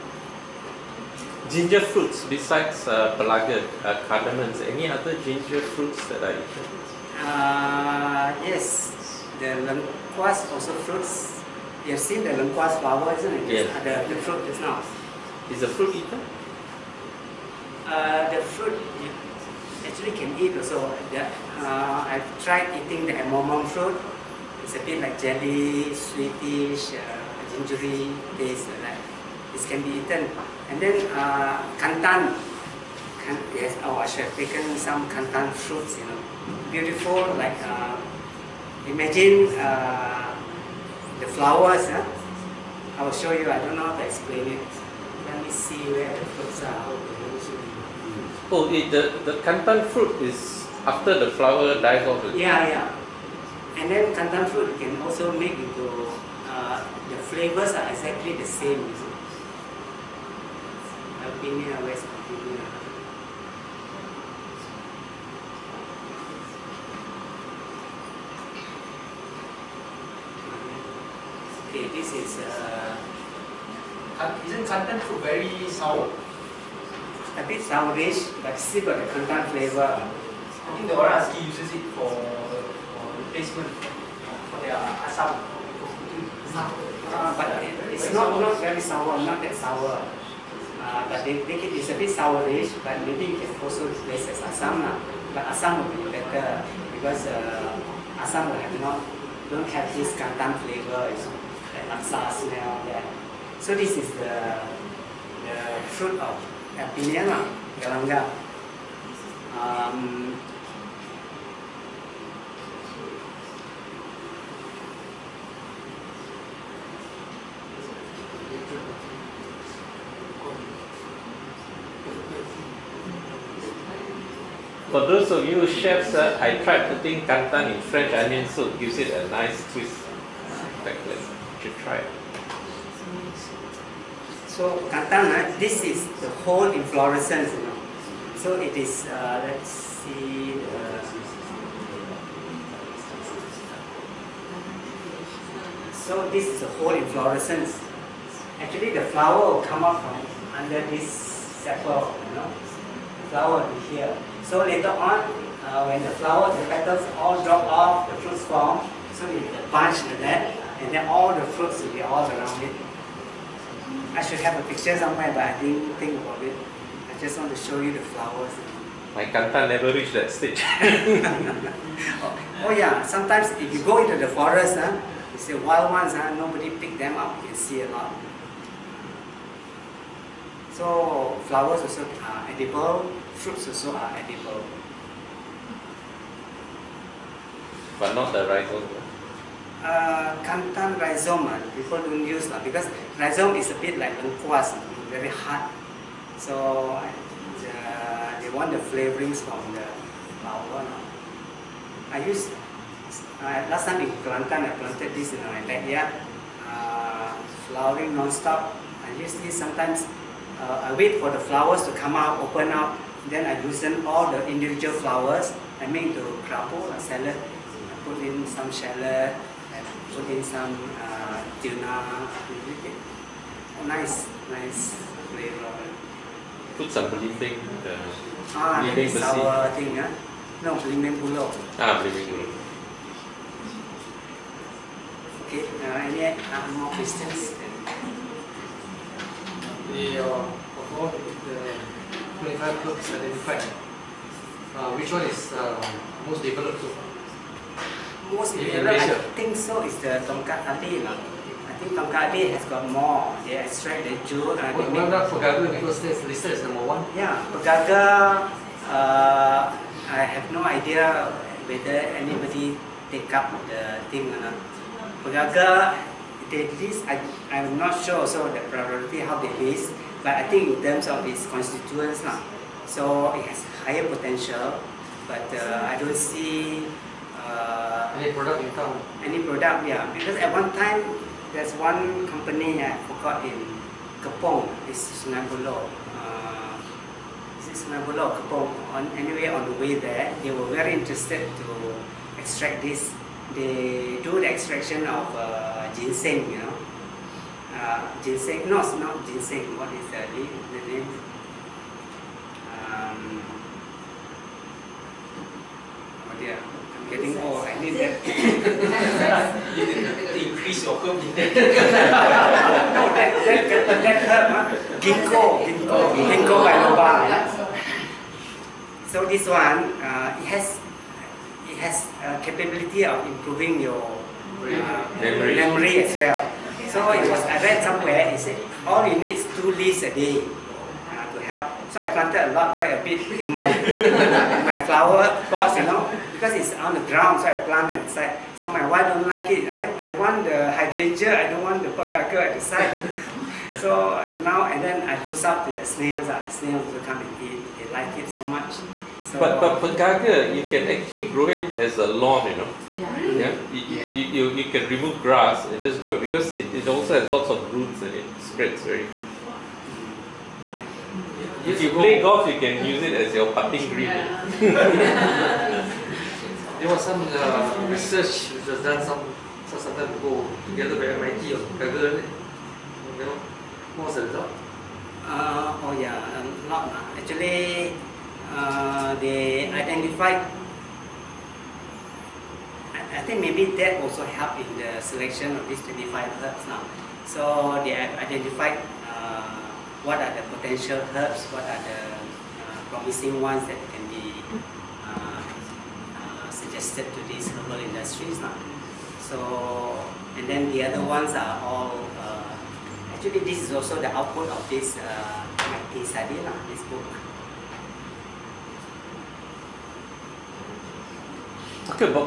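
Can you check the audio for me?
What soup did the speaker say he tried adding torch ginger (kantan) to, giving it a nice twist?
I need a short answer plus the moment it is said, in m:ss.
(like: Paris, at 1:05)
French onion soup, at 2:07.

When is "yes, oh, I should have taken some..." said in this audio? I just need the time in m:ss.
0:33.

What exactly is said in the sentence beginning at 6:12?
You know, what was the result?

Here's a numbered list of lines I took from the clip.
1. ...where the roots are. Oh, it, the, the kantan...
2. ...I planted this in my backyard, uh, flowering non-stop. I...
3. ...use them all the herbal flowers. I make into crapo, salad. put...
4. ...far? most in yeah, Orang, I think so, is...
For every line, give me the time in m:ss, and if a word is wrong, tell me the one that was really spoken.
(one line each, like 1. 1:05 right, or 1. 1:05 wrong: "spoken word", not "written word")
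1. 0:45 wrong: "fruits", not "roots"
2. 3:24 right
3. 3:33 wrong: "individual", not "herbal"
4. 4:06 wrong: "Europe", not "Orang".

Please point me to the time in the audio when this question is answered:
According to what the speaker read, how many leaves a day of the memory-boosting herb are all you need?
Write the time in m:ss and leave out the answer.
5:29.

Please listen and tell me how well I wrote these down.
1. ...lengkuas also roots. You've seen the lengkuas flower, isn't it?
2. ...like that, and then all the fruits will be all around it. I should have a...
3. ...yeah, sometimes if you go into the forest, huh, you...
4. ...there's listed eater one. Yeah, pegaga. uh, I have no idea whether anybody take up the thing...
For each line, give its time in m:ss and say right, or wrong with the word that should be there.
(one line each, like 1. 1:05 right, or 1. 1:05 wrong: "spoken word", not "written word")
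1. 0:09 wrong: "fruits", not "roots"
2. 2:40 right
3. 2:52 right
4. 4:16 wrong: "number", not "eater".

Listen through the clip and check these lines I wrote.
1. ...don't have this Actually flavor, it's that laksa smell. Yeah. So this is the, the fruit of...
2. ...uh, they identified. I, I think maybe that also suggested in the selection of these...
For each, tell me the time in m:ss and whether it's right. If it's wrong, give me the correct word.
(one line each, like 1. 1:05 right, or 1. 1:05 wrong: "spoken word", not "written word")
1. 1:39 wrong: "Kantan", not "Actually"
2. 6:18 wrong: "helped", not "suggested".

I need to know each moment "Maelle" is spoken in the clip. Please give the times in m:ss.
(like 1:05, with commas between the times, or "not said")
not said.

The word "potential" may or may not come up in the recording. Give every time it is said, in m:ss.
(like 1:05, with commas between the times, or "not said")
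4:34, 6:30.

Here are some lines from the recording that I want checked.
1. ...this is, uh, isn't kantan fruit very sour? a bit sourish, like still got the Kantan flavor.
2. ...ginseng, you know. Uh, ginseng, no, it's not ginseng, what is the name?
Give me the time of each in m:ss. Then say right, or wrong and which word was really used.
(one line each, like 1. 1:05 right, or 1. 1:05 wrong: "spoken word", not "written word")
1. 1:11 right
2. 4:55 right.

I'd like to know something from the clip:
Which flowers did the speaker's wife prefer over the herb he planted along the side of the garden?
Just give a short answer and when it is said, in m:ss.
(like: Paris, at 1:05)
Hydrangea, at 5:40.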